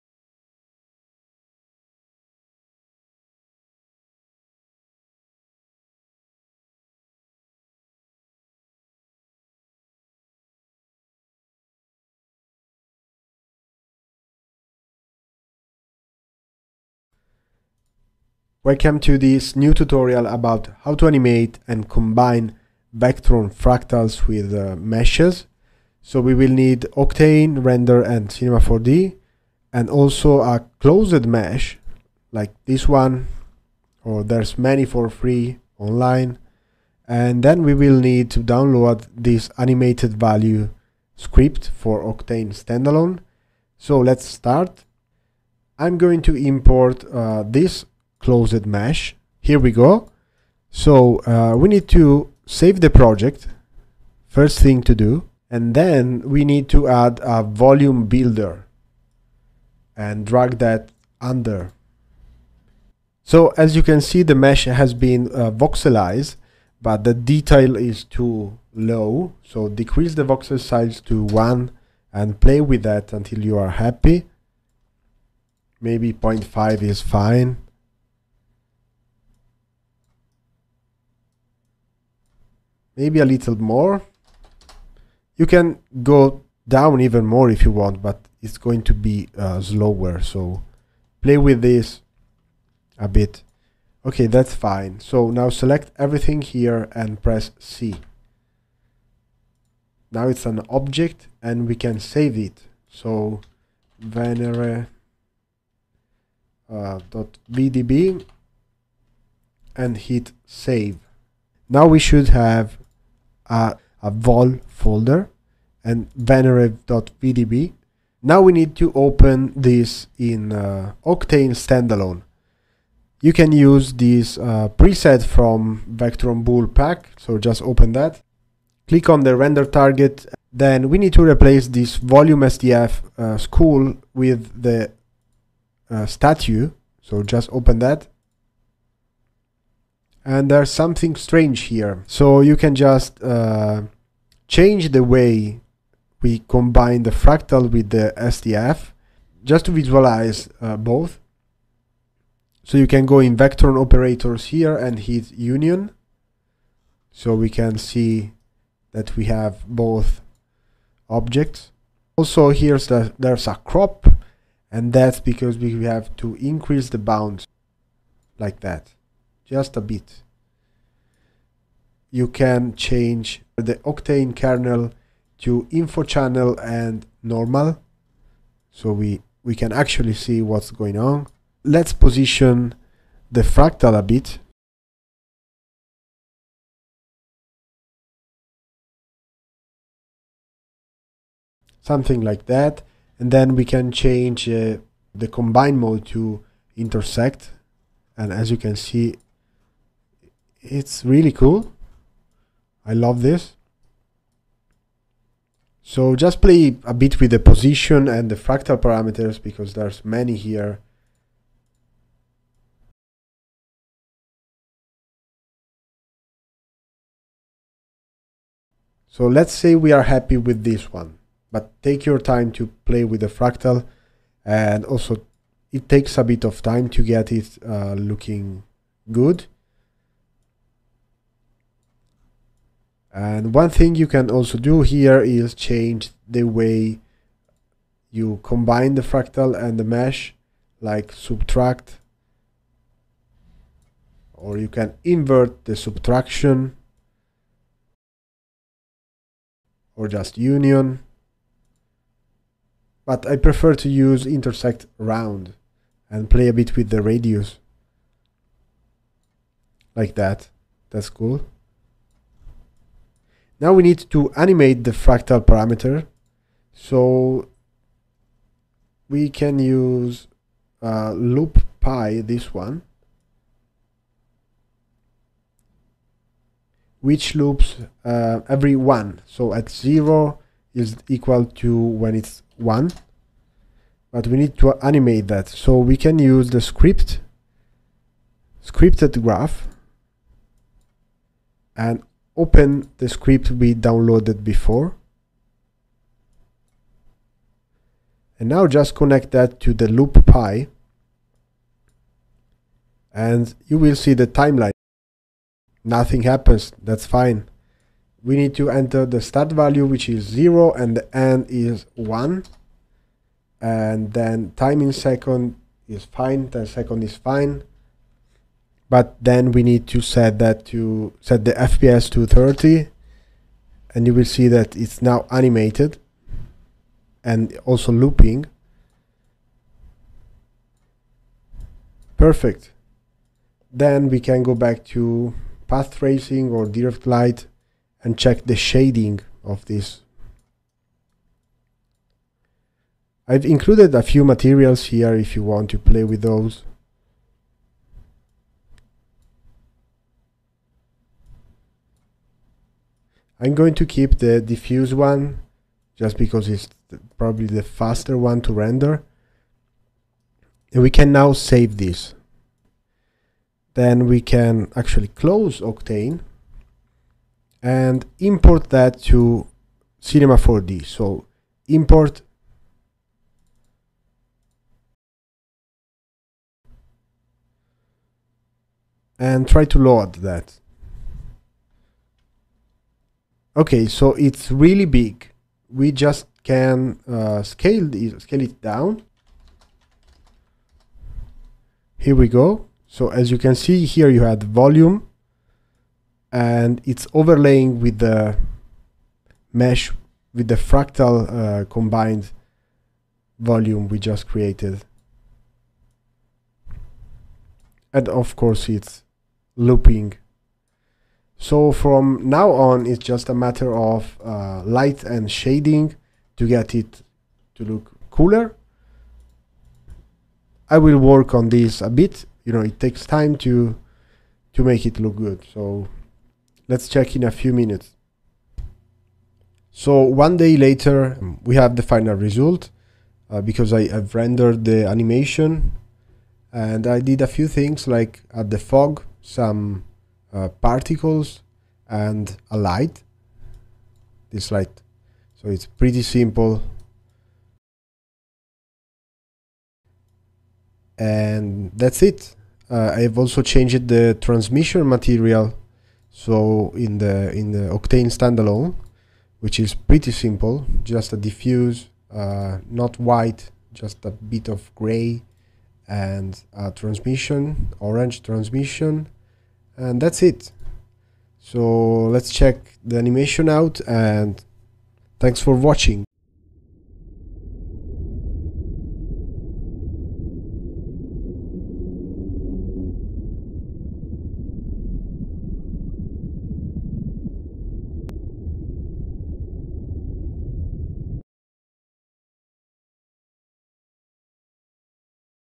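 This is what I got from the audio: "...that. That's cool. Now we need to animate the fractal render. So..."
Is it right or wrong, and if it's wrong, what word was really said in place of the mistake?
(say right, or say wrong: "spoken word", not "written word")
wrong: "parameter", not "render".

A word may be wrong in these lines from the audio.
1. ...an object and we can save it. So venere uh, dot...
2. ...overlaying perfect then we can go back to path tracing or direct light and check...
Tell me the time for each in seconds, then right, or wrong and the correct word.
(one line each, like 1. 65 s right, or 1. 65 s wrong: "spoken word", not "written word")
1. 100 s right
2. 327 s wrong: "looping", not "overlaying".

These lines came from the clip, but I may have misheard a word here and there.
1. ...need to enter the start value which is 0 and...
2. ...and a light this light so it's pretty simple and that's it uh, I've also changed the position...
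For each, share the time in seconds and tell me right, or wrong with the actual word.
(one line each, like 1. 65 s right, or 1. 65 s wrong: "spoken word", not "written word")
1. 308 s right
2. 441 s wrong: "transmission", not "position".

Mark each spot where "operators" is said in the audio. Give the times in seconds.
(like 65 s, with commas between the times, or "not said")
153 s.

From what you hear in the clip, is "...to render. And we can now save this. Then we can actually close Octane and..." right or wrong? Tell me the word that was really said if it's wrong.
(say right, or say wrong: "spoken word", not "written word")
right.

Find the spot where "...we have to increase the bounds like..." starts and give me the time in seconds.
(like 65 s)
165 s.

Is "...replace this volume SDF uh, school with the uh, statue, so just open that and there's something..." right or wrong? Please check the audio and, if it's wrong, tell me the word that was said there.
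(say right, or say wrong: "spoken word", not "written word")
right.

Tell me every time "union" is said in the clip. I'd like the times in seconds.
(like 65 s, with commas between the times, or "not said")
155 s, 250 s.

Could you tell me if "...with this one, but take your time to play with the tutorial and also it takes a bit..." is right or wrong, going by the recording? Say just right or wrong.
wrong.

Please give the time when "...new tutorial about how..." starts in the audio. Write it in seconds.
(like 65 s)
19 s.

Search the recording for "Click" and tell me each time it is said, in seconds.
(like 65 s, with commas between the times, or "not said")
128 s.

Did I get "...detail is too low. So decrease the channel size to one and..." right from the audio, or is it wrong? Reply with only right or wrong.
wrong.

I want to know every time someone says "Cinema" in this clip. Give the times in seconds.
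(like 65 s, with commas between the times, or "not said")
28 s, 369 s.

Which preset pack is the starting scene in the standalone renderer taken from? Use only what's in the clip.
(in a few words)
Vectron Boole pack.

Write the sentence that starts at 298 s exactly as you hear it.
And now just connect that to the loop pi and you will see the timeline.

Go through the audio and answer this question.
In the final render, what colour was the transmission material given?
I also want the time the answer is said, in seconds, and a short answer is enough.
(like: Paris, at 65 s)
orange, at 467 s.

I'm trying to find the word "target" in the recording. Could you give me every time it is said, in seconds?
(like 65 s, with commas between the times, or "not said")
129 s.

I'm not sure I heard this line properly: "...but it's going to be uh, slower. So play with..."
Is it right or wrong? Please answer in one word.
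right.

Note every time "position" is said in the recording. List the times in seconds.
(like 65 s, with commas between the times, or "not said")
181 s, 207 s.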